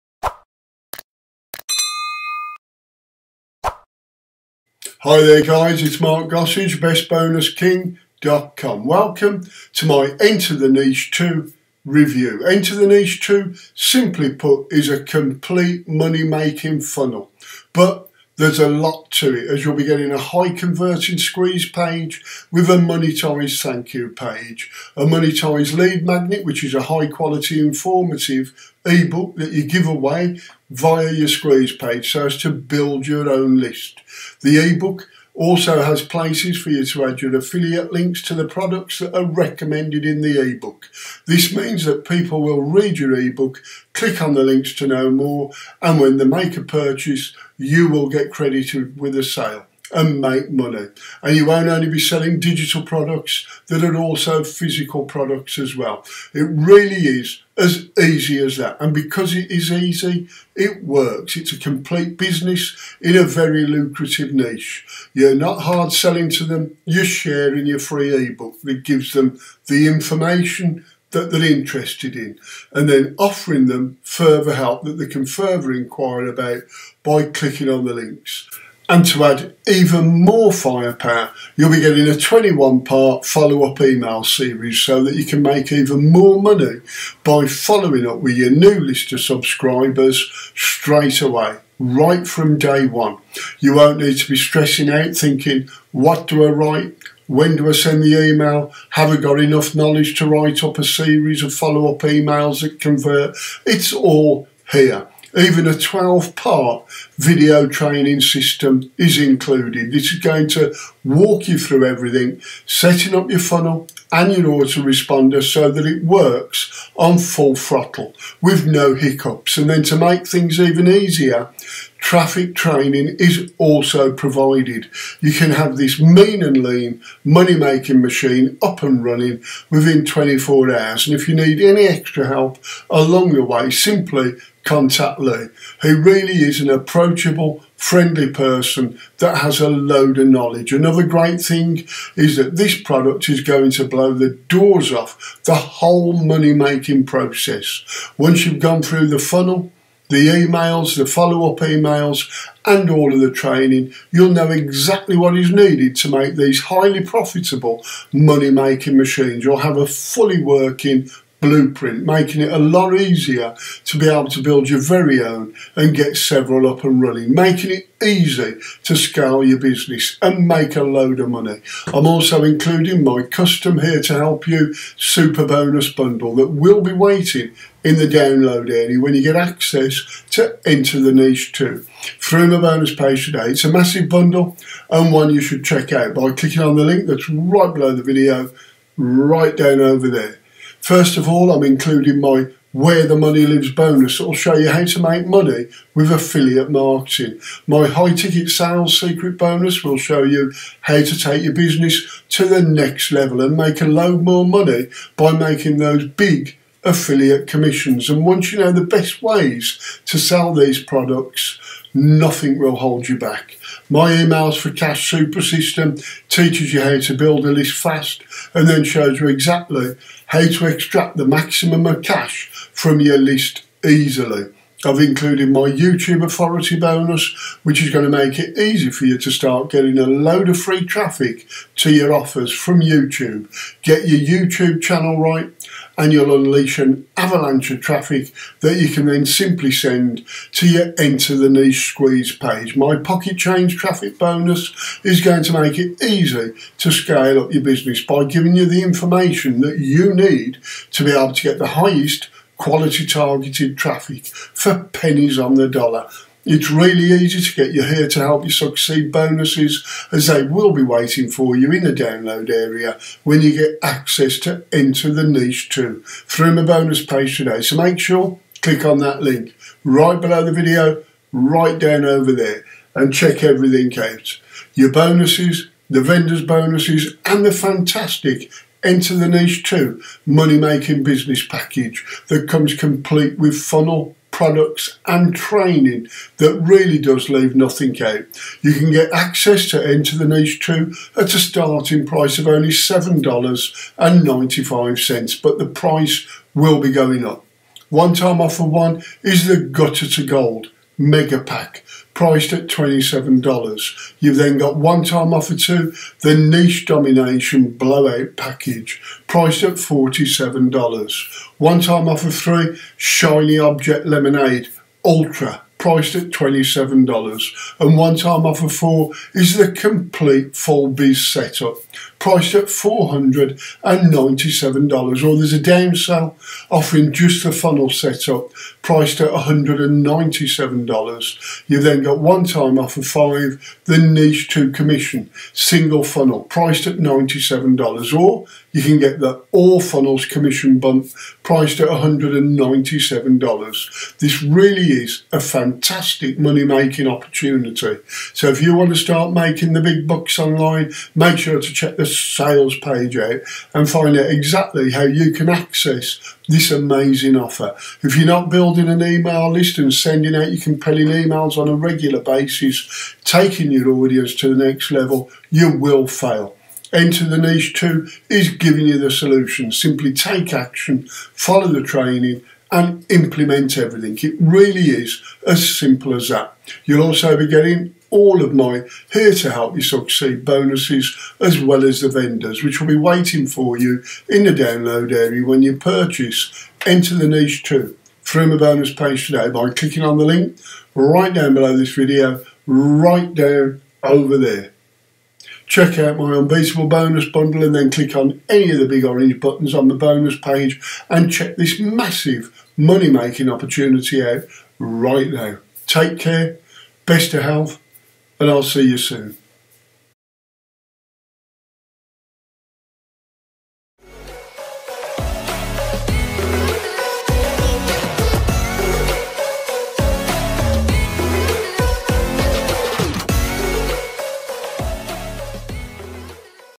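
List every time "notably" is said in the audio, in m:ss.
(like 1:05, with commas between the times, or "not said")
not said.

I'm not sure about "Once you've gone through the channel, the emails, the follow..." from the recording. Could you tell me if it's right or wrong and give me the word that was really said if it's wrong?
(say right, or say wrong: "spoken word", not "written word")
wrong: "funnel", not "channel".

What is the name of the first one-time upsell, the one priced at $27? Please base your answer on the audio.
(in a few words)
Gutter to Gold Mega Pack.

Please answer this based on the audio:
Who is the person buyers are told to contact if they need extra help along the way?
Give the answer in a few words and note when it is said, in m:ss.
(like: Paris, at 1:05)
Lee, at 2:15.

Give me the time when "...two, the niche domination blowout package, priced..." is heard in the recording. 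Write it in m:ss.
5:05.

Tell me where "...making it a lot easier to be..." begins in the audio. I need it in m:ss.
2:42.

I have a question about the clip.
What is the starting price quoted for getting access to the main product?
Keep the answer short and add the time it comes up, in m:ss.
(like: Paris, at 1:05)
$7.95, at 4:52.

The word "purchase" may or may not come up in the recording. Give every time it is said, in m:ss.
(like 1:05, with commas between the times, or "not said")
0:46, 6:25.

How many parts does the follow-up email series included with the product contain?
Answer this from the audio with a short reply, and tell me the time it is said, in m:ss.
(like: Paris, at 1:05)
21, at 1:22.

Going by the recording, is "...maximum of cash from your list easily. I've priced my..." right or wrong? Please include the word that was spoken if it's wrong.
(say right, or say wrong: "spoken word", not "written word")
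wrong: "included", not "priced".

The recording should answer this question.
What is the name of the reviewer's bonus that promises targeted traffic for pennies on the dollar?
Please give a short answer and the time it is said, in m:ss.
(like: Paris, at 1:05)
Pocket Change Traffic, at 4:02.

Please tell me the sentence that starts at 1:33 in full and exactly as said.
You won't need to be stressing out thinking, what do I write?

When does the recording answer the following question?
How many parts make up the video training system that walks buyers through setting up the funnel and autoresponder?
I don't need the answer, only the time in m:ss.
1:45.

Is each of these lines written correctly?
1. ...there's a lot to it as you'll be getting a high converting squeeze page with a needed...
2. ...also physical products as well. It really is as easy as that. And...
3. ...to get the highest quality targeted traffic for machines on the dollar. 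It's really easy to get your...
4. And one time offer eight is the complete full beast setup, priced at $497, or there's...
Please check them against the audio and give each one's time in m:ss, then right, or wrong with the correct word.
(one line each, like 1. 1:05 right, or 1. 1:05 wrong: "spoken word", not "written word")
1. 0:18 wrong: "monetized", not "needed"
2. 0:53 right
3. 4:11 wrong: "pennies", not "machines"
4. 5:17 wrong: "four", not "eight".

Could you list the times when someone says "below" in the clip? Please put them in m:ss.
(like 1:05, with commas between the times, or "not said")
3:07, 4:30, 6:31.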